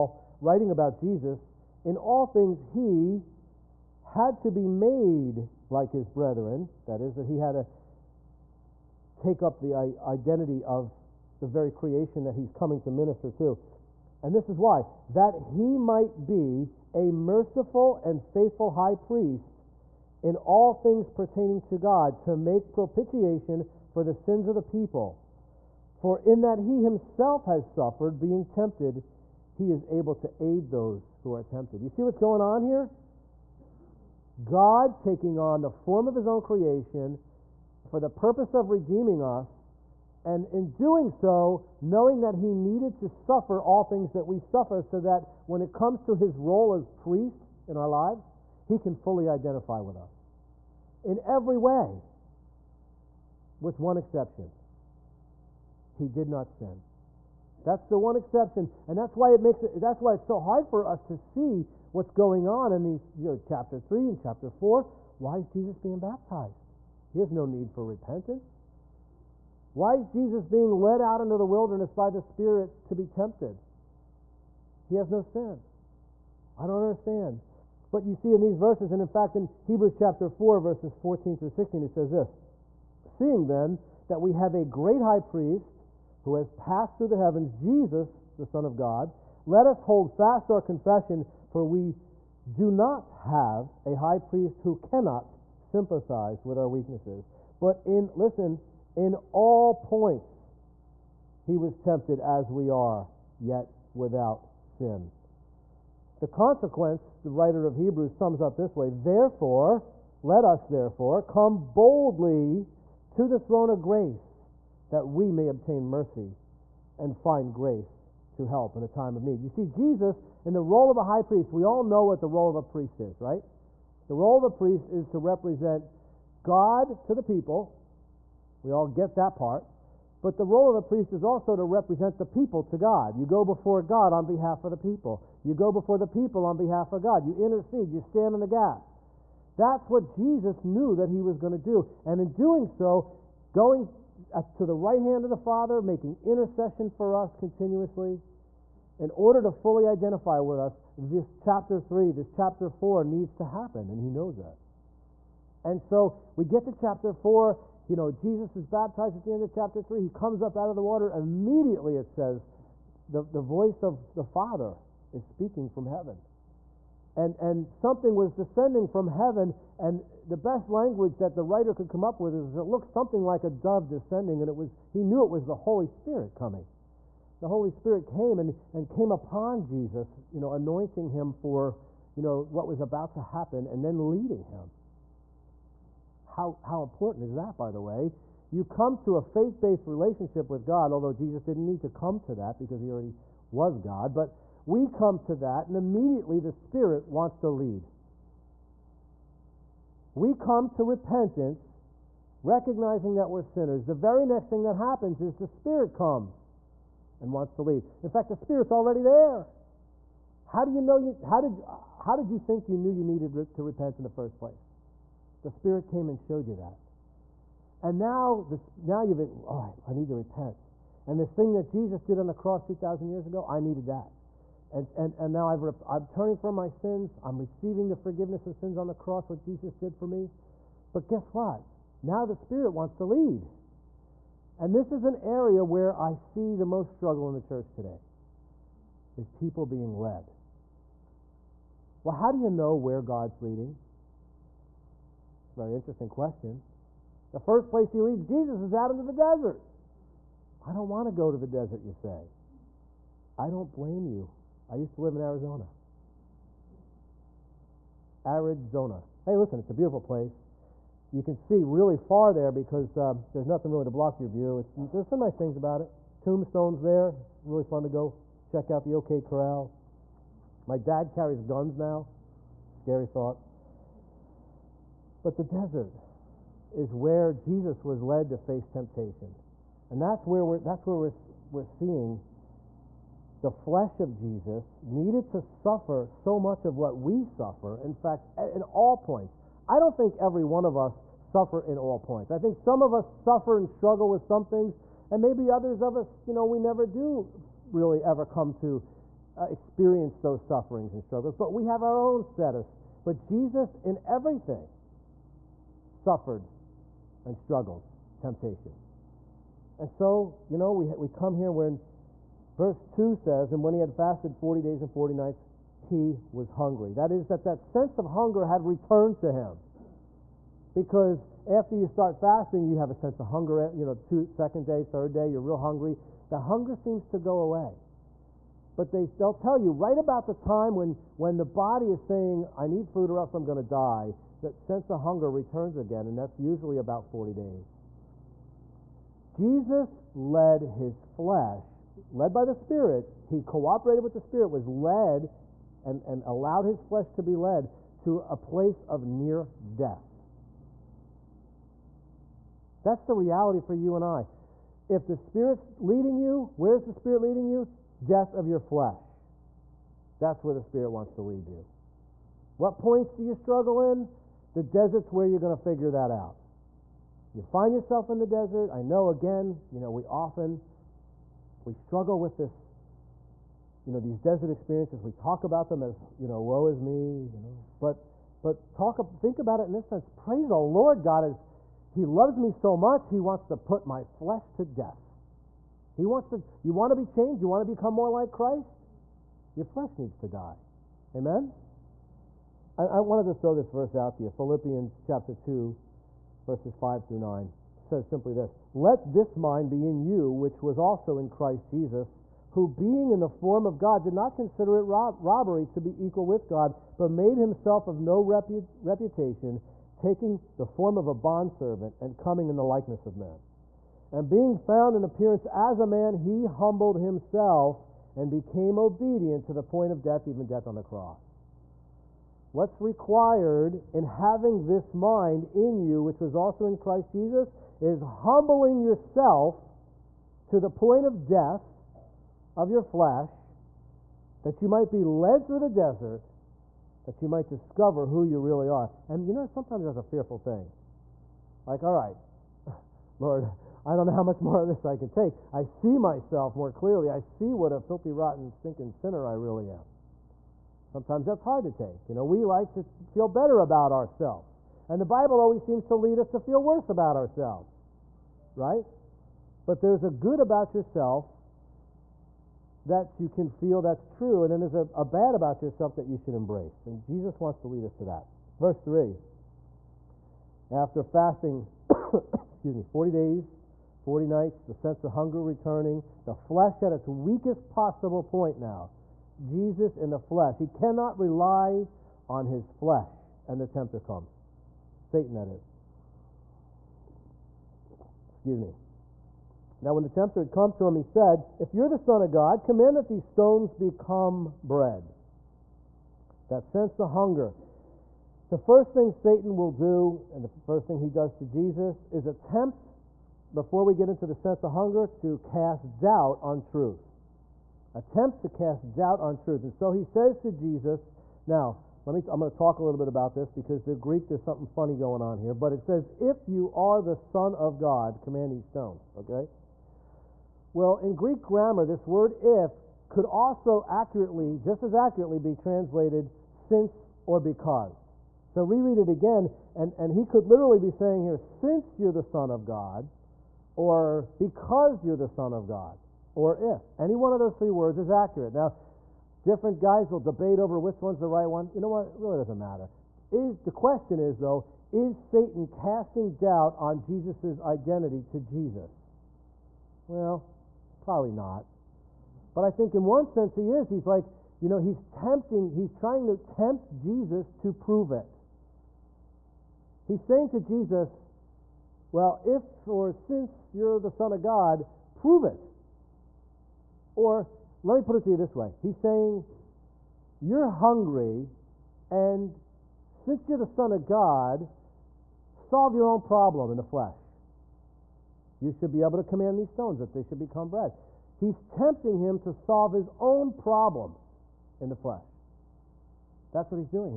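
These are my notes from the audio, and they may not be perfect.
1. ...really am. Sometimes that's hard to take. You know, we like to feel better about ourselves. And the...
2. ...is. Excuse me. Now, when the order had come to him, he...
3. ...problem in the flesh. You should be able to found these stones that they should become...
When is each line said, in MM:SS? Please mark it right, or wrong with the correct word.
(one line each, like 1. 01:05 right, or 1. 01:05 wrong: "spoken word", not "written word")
1. 07:29 right
2. 08:05 wrong: "tempter", not "order"
3. 09:36 wrong: "command", not "found".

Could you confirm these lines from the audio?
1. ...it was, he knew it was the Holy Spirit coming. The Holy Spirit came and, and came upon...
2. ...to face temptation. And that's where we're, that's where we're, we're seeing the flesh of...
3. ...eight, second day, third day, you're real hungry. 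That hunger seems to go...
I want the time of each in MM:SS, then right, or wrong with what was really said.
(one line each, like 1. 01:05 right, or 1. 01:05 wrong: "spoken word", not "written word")
1. 02:54 right
2. 04:38 right
3. 05:23 wrong: "two", not "eight".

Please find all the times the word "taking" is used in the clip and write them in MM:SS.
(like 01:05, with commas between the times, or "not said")
00:34, 06:49.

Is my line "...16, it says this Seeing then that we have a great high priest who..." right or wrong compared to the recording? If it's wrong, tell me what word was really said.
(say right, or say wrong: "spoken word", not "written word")
right.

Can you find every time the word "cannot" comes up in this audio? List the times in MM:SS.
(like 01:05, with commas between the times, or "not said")
01:34, 08:00.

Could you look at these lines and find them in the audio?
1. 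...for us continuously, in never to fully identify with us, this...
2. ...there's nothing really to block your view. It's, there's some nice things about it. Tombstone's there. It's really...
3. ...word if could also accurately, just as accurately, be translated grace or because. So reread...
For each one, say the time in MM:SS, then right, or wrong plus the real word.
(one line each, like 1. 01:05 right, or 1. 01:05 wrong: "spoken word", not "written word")
1. 02:26 wrong: "order", not "never"
2. 04:23 right
3. 08:42 wrong: "since", not "grace".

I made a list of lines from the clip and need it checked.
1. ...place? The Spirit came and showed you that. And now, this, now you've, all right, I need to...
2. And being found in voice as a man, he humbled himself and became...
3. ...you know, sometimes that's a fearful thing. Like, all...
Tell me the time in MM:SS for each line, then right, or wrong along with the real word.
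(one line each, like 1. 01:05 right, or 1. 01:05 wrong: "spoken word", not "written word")
1. 03:34 right
2. 06:54 wrong: "appearance", not "voice"
3. 07:19 right.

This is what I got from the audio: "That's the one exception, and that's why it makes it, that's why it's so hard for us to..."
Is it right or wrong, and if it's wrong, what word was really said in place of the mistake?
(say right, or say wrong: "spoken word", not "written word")
right.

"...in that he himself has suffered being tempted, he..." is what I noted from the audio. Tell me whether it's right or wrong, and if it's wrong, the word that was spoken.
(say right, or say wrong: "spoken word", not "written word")
right.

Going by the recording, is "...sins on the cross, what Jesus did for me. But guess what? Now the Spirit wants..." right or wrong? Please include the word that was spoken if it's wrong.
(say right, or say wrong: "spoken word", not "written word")
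right.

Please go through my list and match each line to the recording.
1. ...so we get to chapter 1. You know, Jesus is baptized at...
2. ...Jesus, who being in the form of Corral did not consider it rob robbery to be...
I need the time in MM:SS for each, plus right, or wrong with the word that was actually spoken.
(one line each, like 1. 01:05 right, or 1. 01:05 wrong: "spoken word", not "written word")
1. 02:35 wrong: "4", not "1"
2. 06:41 wrong: "God", not "Corral".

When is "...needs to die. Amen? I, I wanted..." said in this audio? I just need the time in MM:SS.
06:29.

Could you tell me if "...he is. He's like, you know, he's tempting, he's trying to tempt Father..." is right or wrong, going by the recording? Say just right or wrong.
wrong.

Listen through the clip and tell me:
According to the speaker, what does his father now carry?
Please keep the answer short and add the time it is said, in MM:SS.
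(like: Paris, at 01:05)
Guns, at 04:31.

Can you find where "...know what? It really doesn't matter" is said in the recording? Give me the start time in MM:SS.
09:01.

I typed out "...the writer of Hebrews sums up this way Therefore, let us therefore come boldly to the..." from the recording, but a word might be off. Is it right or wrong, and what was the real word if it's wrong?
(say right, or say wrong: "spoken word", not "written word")
right.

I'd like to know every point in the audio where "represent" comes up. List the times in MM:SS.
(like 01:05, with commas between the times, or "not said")
02:05, 02:11.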